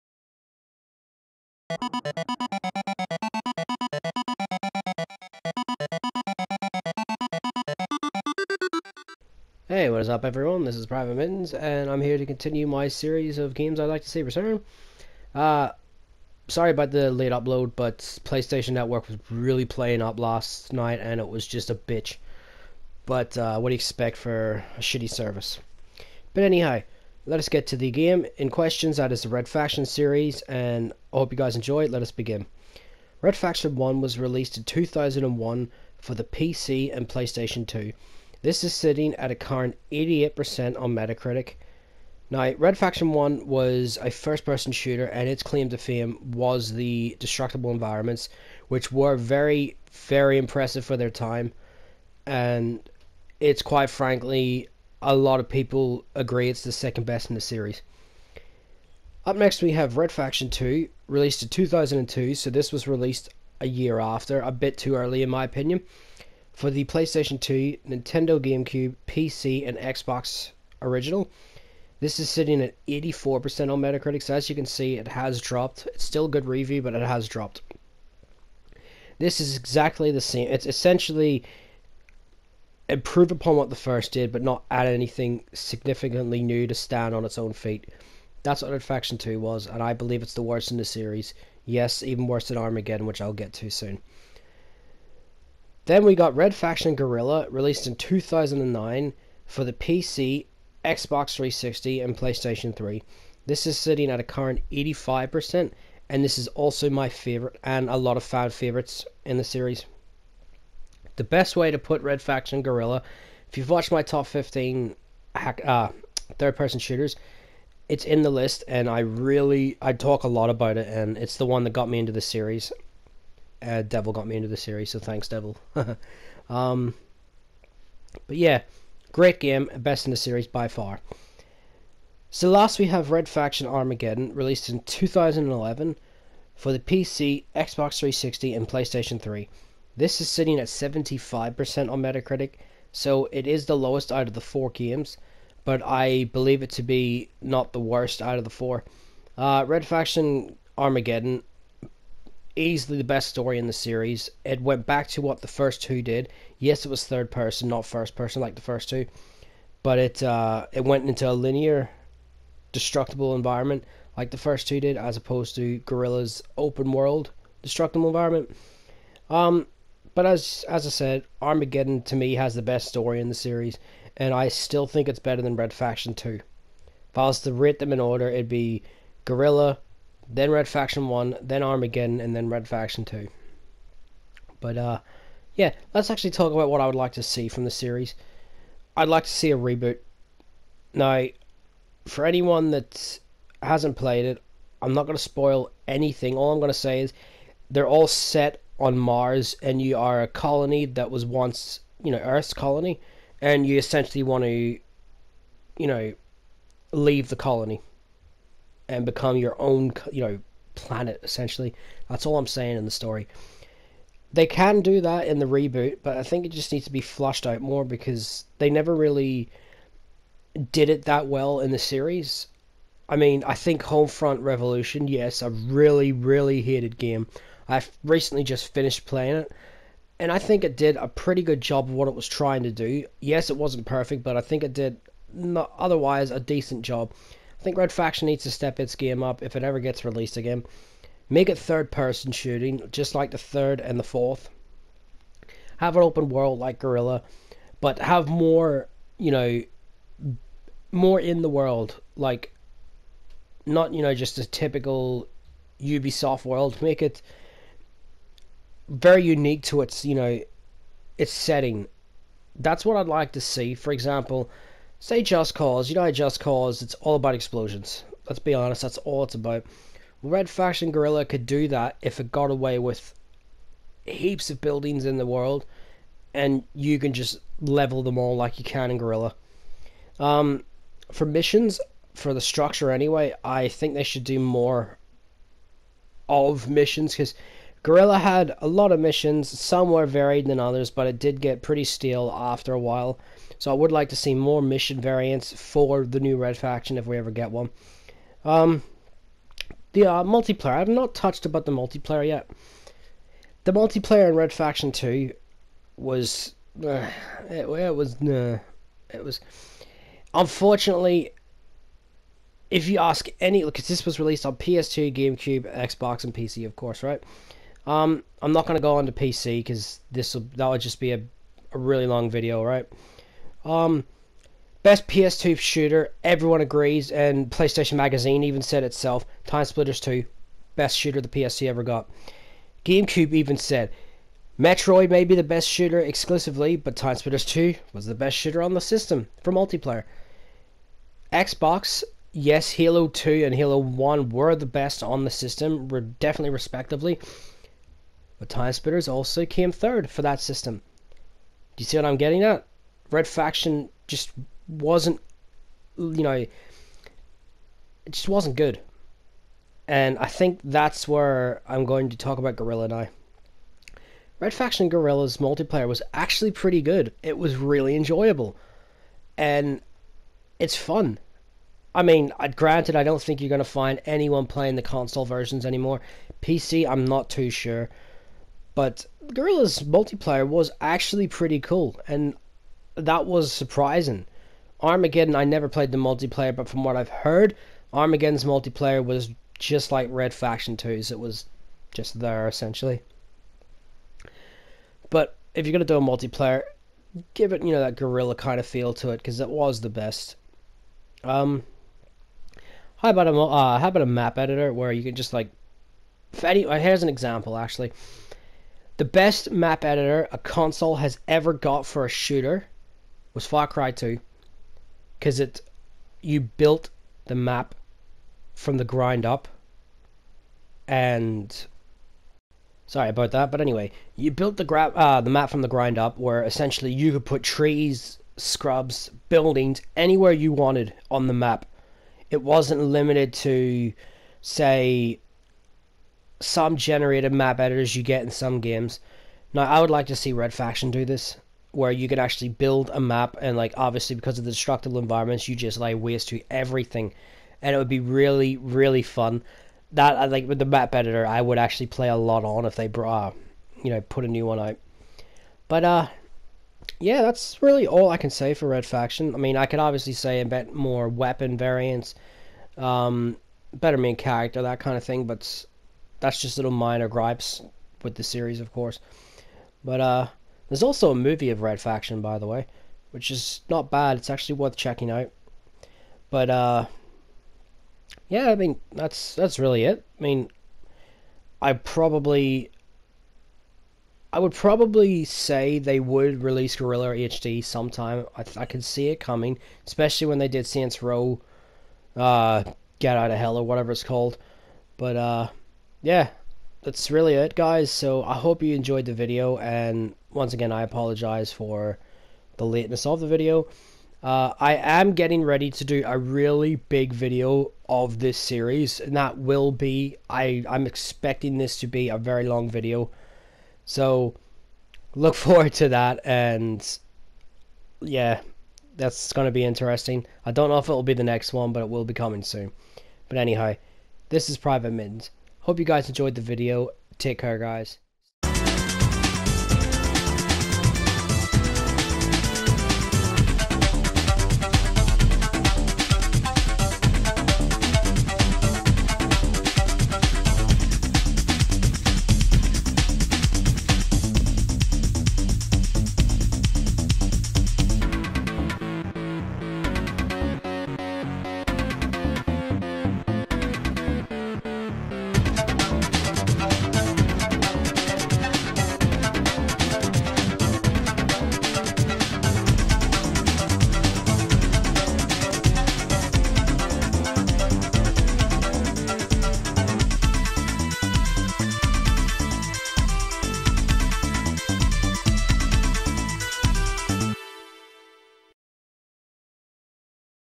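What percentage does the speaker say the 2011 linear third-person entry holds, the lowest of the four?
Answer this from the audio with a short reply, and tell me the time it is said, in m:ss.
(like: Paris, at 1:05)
75%, at 2:20.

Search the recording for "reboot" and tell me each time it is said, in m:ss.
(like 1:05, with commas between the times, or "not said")
3:09, 3:35.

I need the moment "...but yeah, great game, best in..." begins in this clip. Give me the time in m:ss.
2:08.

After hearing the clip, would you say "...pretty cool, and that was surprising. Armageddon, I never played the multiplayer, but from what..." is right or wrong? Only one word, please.
right.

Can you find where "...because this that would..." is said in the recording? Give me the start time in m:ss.
5:19.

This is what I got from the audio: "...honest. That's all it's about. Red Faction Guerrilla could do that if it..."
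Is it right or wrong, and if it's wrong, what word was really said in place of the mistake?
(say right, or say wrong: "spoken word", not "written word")
right.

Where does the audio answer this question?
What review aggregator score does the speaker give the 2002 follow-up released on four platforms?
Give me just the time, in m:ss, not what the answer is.
1:12.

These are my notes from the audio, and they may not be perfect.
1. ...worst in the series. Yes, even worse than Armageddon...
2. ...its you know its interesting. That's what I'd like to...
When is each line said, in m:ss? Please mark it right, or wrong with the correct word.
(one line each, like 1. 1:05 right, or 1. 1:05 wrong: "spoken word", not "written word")
1. 1:30 right
2. 4:19 wrong: "setting", not "interesting".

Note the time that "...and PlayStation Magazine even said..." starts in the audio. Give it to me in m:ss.
5:27.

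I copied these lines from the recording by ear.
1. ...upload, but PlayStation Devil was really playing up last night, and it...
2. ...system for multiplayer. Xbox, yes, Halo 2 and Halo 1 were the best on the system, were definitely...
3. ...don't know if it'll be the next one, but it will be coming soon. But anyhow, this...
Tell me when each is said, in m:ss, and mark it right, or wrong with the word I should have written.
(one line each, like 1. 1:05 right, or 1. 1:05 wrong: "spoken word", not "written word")
1. 0:17 wrong: "Network", not "Devil"
2. 5:38 right
3. 8:40 right.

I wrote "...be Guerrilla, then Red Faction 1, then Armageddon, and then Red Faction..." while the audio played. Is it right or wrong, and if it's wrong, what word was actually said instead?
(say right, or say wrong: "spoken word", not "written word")
right.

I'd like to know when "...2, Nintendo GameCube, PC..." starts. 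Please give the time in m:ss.
1:07.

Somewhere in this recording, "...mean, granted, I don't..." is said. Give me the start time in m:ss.
6:12.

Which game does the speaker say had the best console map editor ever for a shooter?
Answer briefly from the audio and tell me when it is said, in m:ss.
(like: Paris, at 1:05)
Far Cry 2, at 6:53.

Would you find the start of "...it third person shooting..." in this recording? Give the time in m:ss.
4:01.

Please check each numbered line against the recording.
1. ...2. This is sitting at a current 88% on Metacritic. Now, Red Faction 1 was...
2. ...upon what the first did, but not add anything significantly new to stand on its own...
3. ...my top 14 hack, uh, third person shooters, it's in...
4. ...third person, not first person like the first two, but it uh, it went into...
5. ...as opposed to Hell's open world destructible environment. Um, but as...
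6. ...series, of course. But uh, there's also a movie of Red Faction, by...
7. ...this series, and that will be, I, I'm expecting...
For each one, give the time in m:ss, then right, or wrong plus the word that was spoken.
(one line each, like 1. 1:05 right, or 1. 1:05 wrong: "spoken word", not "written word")
1. 0:37 right
2. 1:23 right
3. 1:53 wrong: "15", not "14"
4. 2:37 right
5. 2:44 wrong: "Guerrilla", not "Hell"
6. 7:48 right
7. 8:28 right.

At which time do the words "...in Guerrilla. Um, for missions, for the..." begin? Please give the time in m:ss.
4:38.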